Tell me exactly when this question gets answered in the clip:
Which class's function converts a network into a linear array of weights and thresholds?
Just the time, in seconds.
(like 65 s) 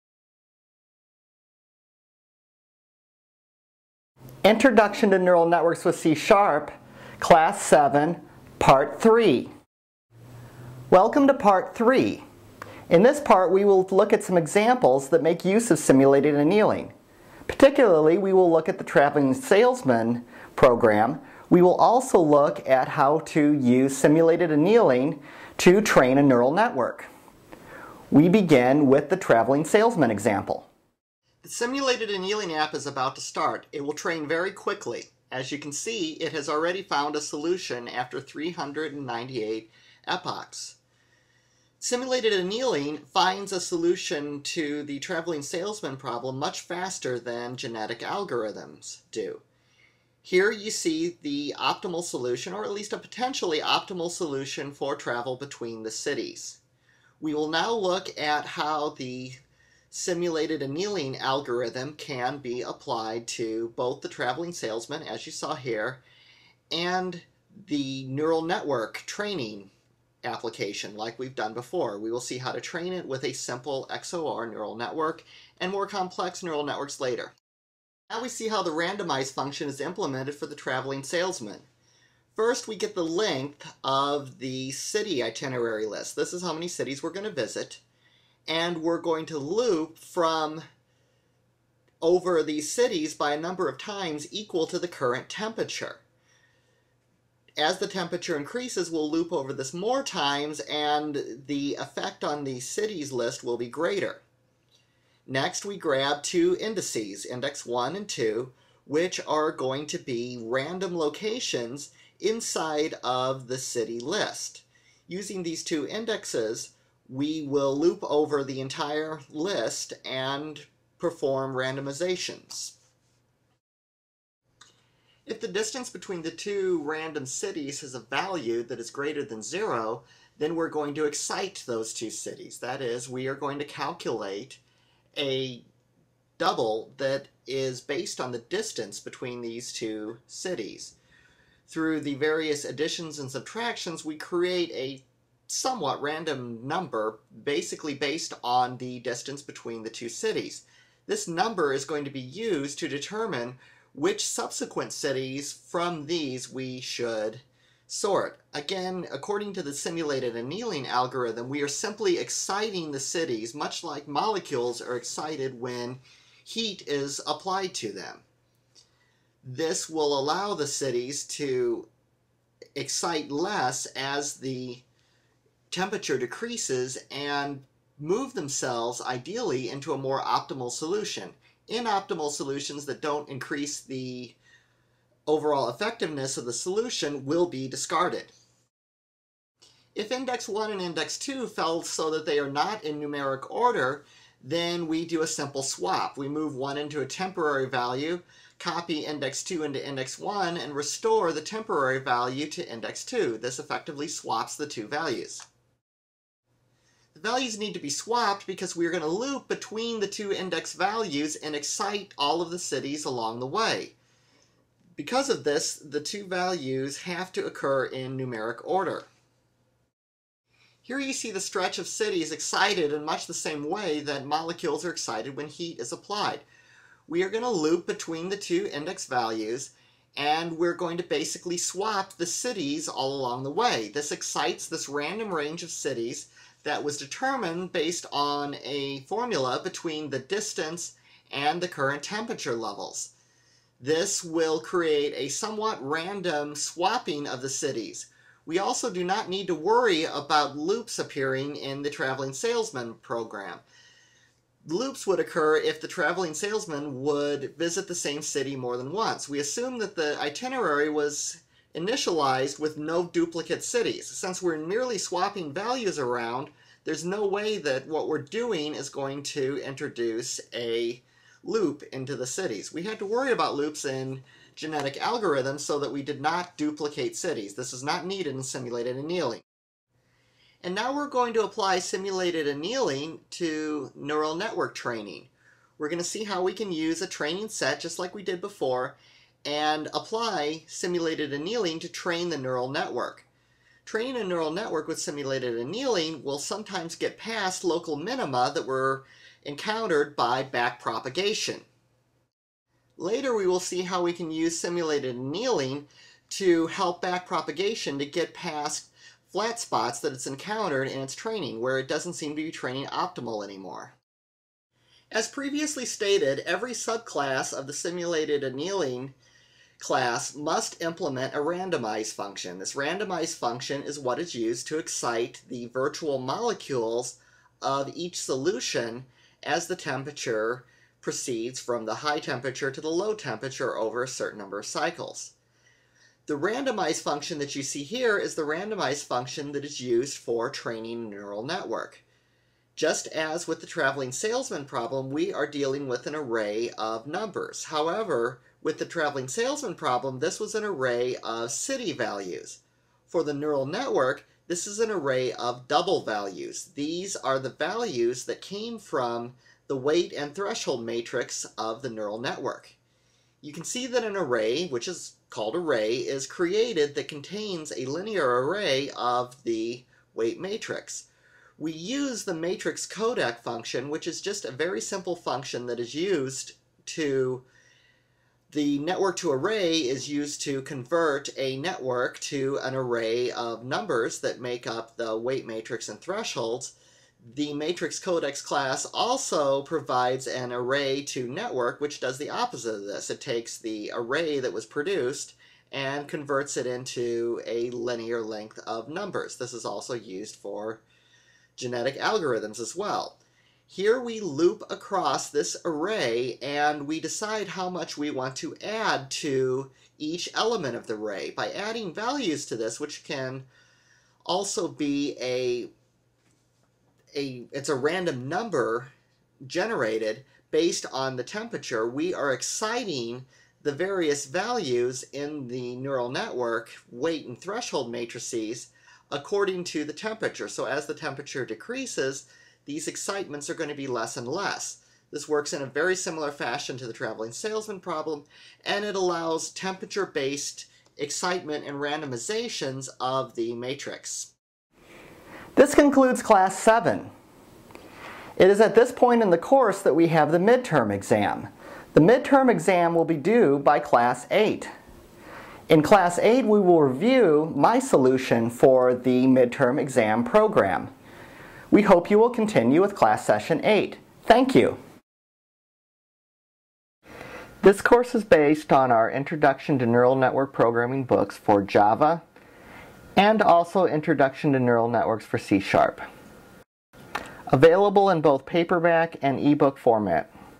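372 s.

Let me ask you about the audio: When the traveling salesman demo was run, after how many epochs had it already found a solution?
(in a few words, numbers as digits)
398.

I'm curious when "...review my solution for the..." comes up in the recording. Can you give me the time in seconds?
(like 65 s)
456 s.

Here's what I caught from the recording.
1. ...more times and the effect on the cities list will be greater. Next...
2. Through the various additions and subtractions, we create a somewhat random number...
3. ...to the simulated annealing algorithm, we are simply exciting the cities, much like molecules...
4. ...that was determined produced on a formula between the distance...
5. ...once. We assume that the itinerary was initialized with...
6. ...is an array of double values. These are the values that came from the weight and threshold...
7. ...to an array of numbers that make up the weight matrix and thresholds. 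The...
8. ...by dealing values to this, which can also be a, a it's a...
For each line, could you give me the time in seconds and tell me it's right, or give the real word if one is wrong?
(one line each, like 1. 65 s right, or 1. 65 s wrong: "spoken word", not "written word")
1. 99 s right
2. 141 s right
3. 159 s right
4. 236 s wrong: "based", not "produced"
5. 258 s right
6. 354 s right
7. 382 s right
8. 411 s wrong: "adding", not "dealing".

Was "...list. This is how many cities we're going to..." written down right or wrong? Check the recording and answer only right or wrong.
right.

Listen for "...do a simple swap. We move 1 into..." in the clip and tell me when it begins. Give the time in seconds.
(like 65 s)
195 s.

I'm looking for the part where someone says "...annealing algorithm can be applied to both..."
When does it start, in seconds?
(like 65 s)
60 s.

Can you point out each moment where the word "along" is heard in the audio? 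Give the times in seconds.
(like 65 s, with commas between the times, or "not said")
213 s, 233 s.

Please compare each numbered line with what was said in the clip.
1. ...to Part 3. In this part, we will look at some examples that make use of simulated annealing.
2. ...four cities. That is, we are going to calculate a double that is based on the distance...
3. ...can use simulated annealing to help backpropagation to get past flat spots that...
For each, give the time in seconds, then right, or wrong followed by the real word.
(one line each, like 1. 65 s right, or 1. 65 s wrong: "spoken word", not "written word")
1. 11 s right
2. 131 s wrong: "two", not "four"
3. 304 s right.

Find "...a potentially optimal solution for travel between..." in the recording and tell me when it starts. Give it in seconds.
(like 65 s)
52 s.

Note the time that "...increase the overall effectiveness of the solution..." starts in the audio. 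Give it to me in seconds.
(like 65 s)
183 s.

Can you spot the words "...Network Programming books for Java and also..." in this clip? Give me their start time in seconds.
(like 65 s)
470 s.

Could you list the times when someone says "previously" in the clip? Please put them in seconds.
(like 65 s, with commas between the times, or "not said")
315 s.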